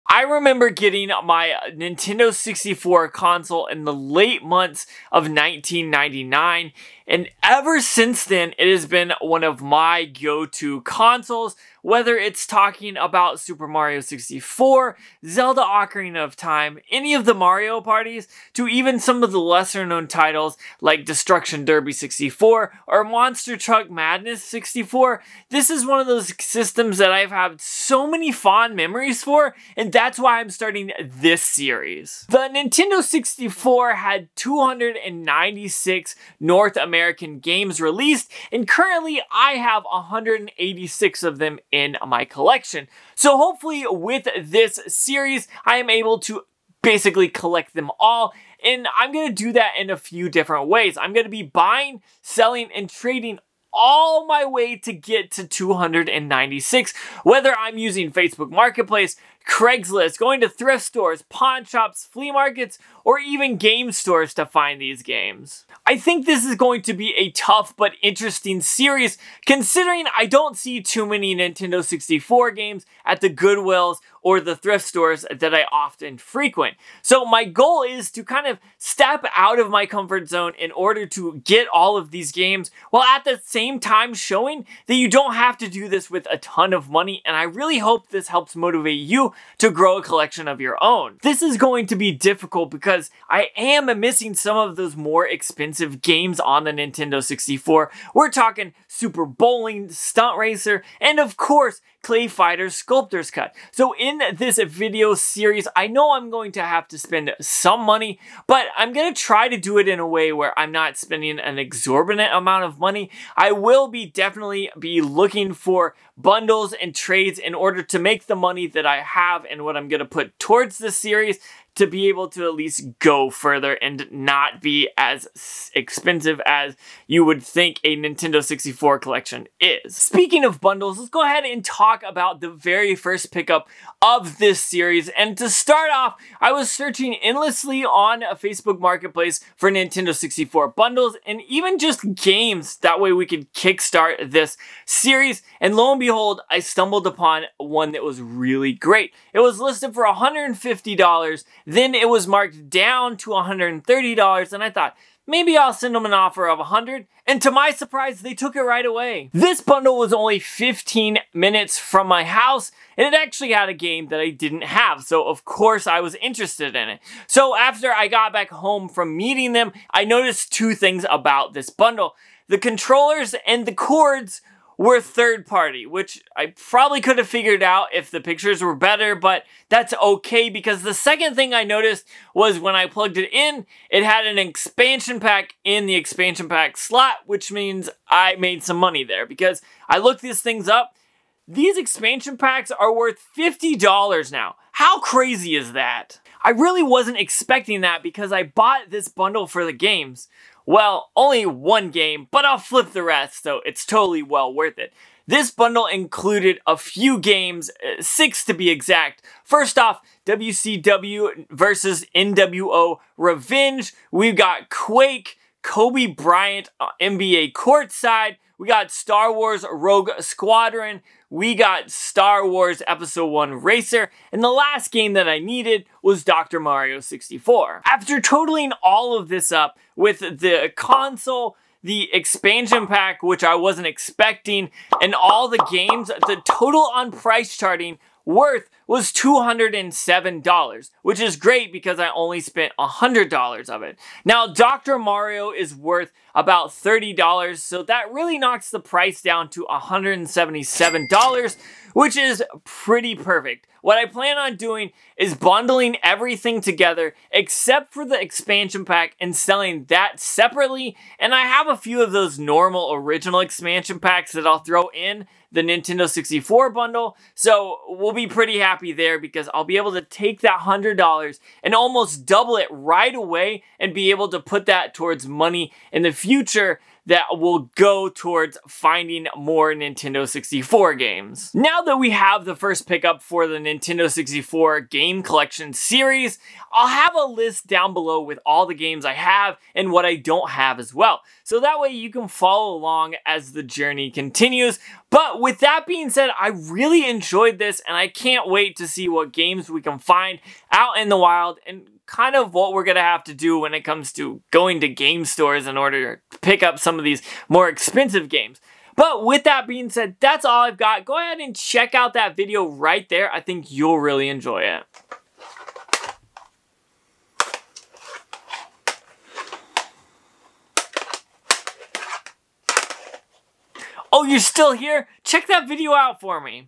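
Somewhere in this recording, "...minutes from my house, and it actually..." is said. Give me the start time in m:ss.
2:41.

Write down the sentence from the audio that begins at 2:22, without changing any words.
That way we could kickstart this series.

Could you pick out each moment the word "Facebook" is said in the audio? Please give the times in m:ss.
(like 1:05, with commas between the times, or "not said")
0:58, 2:18.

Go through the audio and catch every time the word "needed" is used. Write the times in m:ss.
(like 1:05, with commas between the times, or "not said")
3:45.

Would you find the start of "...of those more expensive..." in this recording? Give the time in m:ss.
1:34.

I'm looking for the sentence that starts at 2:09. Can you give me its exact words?
Speaking of bundles, let's go ahead and talk about the very first pickup of this series.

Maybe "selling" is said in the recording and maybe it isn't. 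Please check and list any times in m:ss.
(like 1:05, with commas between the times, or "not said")
0:52, 4:19.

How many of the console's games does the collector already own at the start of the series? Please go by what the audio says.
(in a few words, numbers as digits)
186.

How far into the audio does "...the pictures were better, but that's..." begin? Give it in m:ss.
2:58.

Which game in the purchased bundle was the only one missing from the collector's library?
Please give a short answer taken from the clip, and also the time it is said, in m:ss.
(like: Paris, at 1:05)
Dr. Mario 64, at 3:46.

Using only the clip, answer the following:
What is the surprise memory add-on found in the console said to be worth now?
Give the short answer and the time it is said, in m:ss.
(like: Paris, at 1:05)
$50, at 3:13.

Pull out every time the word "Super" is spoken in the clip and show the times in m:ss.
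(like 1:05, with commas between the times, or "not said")
0:13, 1:38.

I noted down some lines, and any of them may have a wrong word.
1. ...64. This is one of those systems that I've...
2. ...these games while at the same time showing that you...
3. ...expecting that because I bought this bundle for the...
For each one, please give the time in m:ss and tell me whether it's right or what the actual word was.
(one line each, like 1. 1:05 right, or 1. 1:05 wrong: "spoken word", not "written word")
1. 0:24 right
2. 1:22 right
3. 3:17 right.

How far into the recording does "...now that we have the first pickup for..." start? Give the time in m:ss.
4:41.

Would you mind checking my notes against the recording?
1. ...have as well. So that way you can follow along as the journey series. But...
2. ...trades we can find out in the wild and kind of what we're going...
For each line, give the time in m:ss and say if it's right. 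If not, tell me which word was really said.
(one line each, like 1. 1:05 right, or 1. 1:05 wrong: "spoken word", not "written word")
1. 4:50 wrong: "continues", not "series"
2. 4:59 wrong: "games", not "trades".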